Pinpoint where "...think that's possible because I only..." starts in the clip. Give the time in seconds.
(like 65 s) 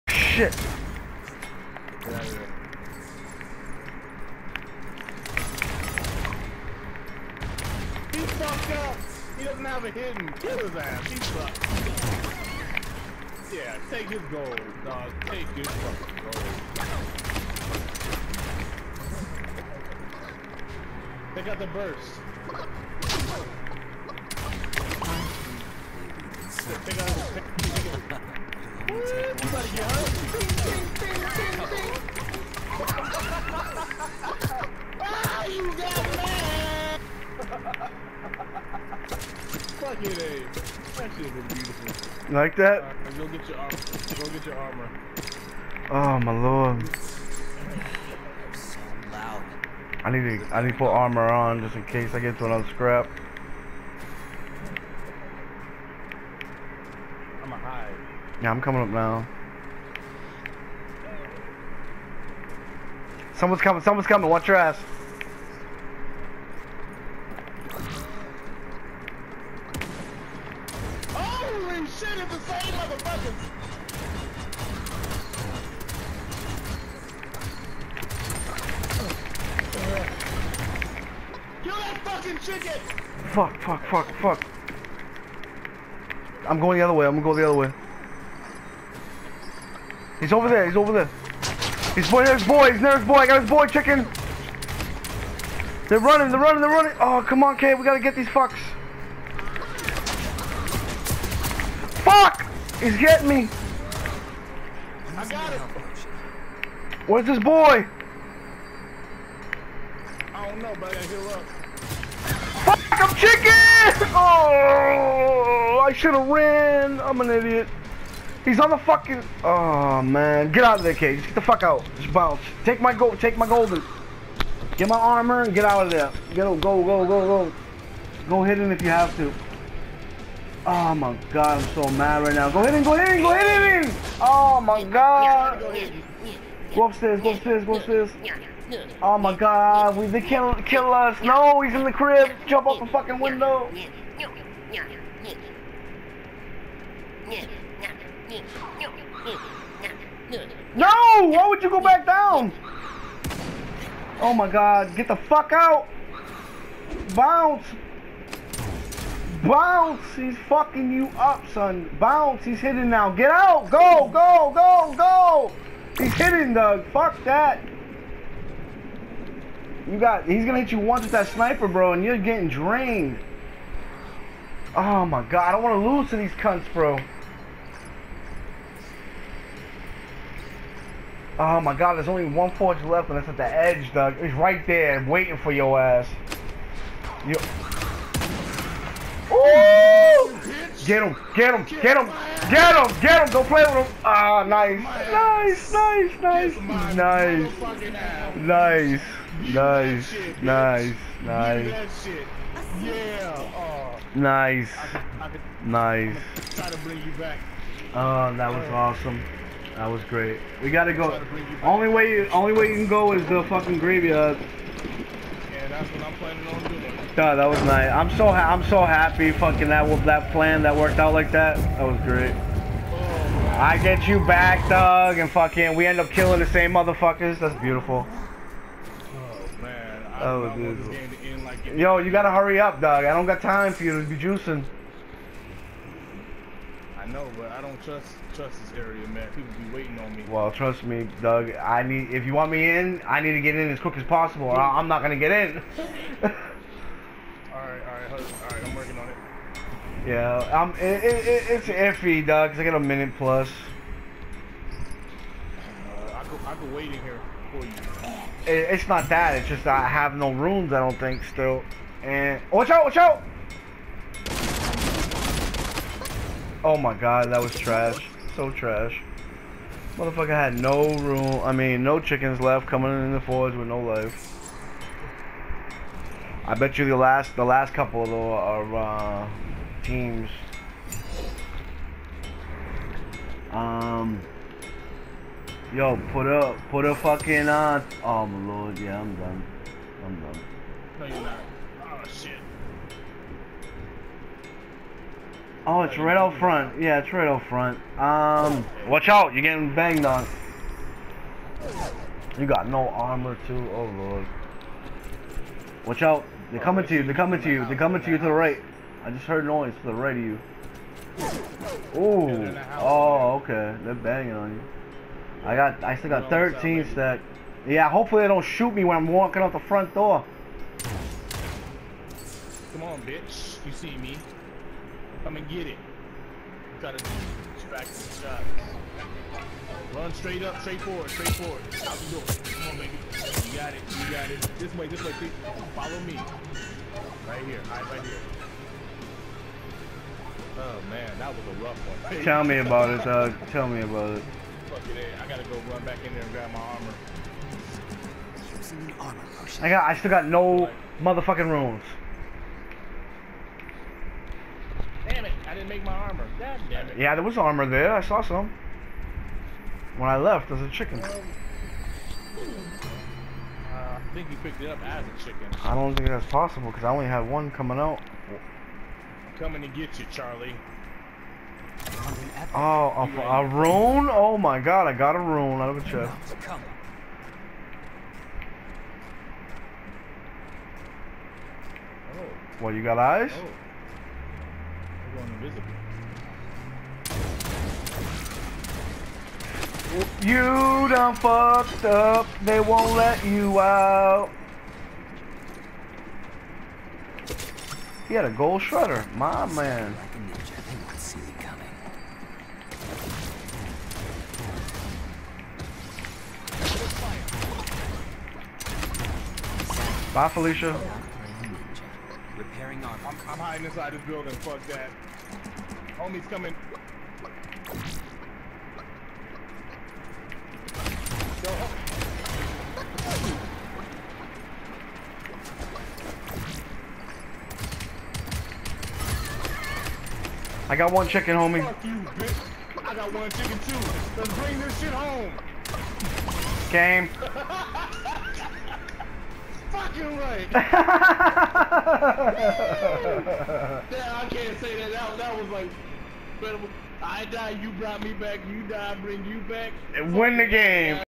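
365 s.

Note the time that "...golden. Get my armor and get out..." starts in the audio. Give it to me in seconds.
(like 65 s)
123 s.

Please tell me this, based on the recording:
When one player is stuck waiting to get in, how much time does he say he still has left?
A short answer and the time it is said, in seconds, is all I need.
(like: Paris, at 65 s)
a minute plus, at 252 s.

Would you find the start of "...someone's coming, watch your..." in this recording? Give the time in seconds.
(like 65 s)
63 s.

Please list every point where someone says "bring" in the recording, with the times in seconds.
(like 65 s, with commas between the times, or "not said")
434 s, 448 s.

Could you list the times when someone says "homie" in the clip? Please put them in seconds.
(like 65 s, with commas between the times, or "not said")
415 s, 431 s.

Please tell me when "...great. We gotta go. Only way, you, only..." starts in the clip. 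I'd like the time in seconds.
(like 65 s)
210 s.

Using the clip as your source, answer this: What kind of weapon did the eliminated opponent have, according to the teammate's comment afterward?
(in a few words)
gold shredder.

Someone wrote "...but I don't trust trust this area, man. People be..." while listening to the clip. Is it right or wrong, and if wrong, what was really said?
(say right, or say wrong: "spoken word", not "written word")
right.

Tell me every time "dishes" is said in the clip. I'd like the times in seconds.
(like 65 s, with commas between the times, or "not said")
not said.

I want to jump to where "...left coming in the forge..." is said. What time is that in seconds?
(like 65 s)
272 s.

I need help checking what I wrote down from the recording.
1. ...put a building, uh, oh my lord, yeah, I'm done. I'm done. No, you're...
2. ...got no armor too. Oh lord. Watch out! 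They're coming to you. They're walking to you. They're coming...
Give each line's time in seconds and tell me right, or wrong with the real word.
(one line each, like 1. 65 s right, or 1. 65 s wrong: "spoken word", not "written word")
1. 286 s wrong: "fucking", not "building"
2. 302 s wrong: "coming", not "walking".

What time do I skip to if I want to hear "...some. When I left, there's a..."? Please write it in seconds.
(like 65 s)
358 s.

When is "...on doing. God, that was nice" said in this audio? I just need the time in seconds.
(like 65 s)
216 s.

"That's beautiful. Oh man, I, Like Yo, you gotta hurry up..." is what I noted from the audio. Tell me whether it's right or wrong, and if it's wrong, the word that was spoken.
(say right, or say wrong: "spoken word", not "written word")
right.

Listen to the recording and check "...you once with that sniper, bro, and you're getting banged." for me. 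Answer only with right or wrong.
wrong.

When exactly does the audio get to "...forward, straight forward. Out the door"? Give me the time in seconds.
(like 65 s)
330 s.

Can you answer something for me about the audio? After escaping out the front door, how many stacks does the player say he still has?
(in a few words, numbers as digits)
13.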